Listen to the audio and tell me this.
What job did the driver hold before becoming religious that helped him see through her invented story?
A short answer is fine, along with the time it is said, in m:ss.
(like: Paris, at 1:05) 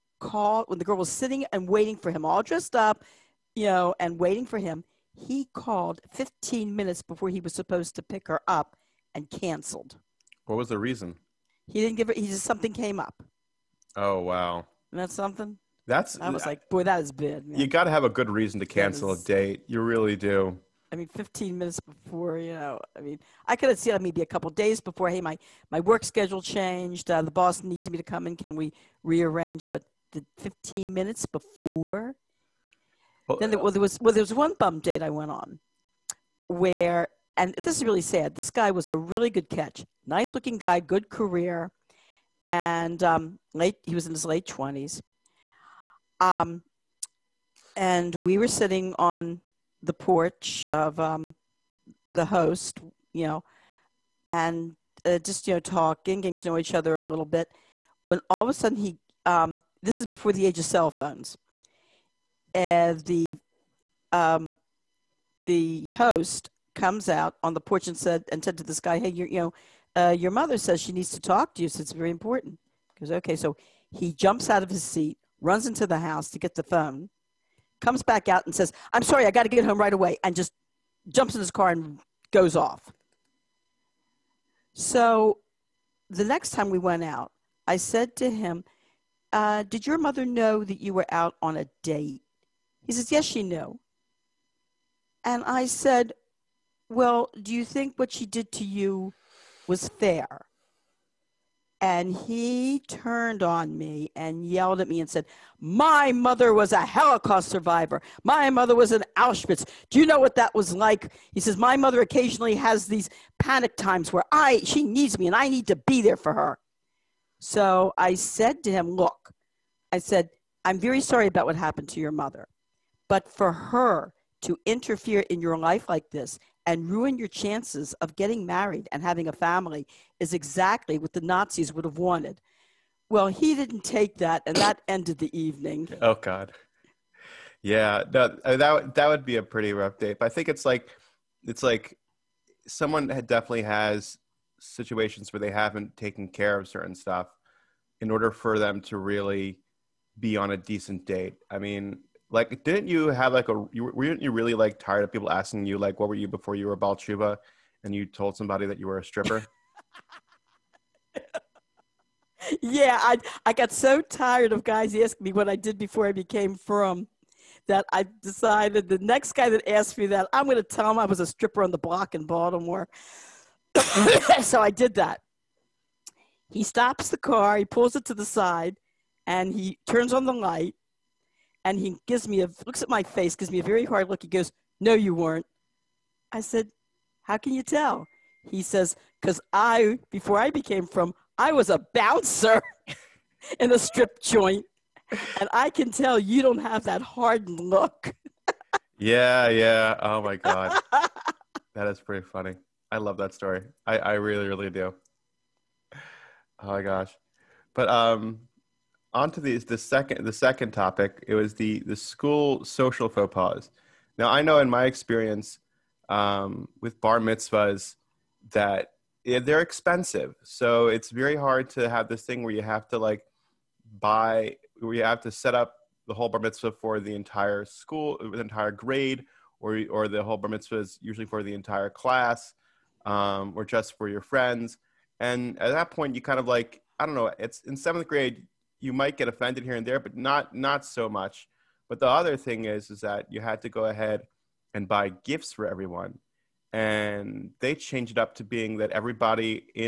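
Bouncer, at 3:11.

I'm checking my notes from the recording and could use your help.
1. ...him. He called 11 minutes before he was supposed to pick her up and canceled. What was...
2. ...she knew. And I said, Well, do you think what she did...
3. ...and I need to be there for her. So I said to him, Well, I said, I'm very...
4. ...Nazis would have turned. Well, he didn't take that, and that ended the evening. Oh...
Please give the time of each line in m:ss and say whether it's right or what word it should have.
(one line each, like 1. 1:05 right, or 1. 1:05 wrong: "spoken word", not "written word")
1. 0:04 wrong: "15", not "11"
2. 1:33 right
3. 1:55 wrong: "Look", not "Well"
4. 2:11 wrong: "wanted", not "turned".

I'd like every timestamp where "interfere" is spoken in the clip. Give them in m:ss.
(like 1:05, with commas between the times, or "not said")
2:04.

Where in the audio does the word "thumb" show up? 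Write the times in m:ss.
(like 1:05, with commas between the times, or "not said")
not said.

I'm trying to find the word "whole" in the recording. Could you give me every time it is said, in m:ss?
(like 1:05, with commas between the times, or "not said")
3:46, 3:50.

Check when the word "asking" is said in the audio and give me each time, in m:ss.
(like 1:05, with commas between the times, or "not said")
2:35, 2:44.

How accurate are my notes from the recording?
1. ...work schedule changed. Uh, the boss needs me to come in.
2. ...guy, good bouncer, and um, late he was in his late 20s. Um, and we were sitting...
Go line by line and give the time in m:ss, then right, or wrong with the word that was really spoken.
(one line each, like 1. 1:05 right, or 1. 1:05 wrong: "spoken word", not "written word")
1. 0:25 right
2. 0:40 wrong: "career", not "bouncer".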